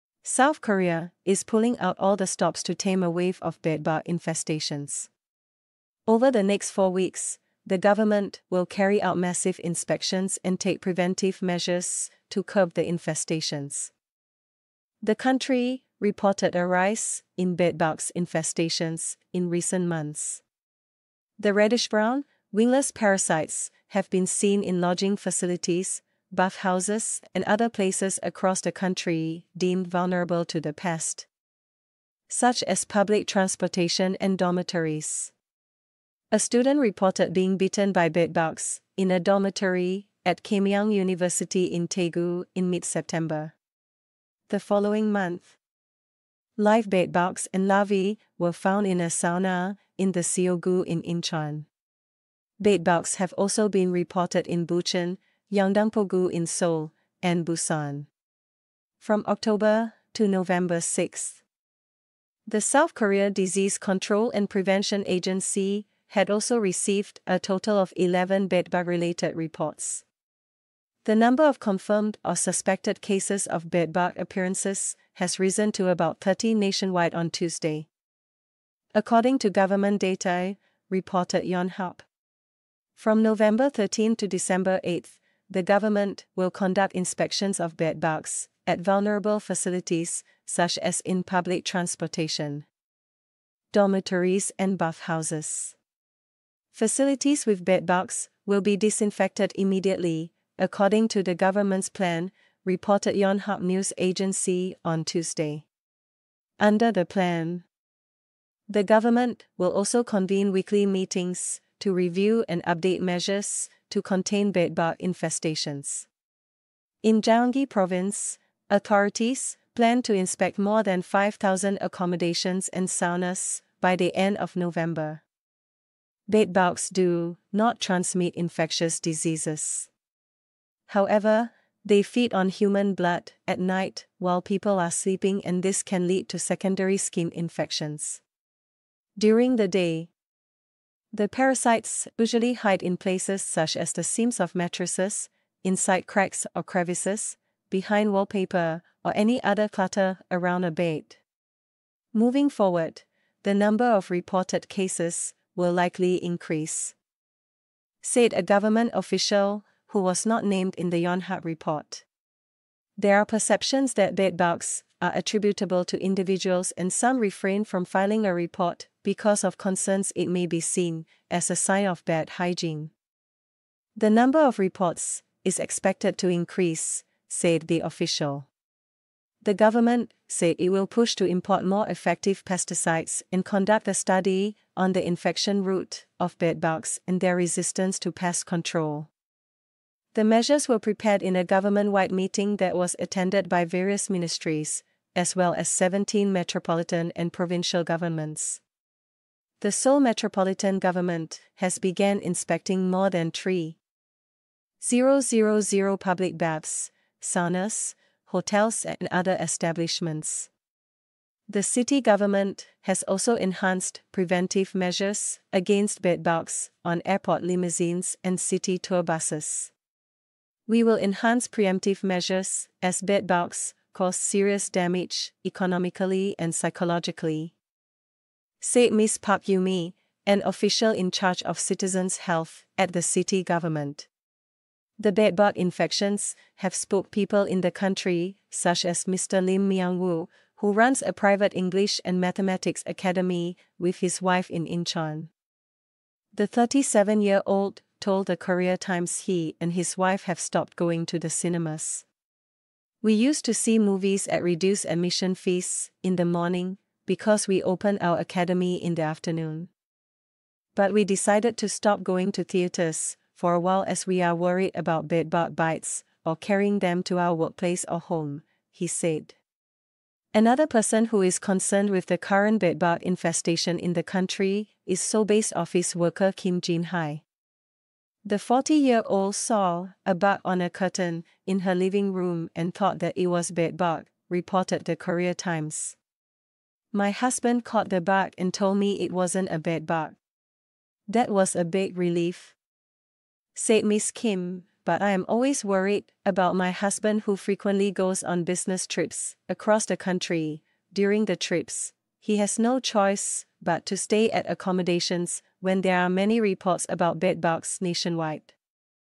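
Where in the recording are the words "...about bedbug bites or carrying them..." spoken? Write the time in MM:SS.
04:24.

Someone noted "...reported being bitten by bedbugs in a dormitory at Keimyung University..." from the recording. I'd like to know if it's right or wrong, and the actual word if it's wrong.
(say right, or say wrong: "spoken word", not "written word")
right.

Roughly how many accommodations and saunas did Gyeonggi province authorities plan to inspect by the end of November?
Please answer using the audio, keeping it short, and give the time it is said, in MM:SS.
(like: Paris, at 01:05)
5,000, at 02:01.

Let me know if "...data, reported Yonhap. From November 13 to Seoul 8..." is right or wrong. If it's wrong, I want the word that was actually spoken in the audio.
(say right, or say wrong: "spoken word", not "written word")
wrong: "December", not "Seoul".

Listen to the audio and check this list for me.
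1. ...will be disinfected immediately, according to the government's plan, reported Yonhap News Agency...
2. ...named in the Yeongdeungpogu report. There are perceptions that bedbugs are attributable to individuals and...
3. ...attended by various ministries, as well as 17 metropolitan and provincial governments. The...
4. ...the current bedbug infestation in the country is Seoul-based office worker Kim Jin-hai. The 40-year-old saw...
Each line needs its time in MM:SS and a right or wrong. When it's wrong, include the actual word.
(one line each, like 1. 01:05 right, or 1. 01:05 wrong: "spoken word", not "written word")
1. 01:38 right
2. 02:40 wrong: "Yonhap", not "Yeongdeungpogu"
3. 03:12 right
4. 04:32 right.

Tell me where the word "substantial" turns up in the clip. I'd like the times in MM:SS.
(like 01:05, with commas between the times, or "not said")
not said.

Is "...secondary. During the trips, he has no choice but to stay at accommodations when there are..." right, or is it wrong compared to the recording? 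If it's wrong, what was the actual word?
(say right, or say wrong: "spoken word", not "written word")
wrong: "country", not "secondary".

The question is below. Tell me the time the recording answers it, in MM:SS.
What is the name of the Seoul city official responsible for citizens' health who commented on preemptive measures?
03:49.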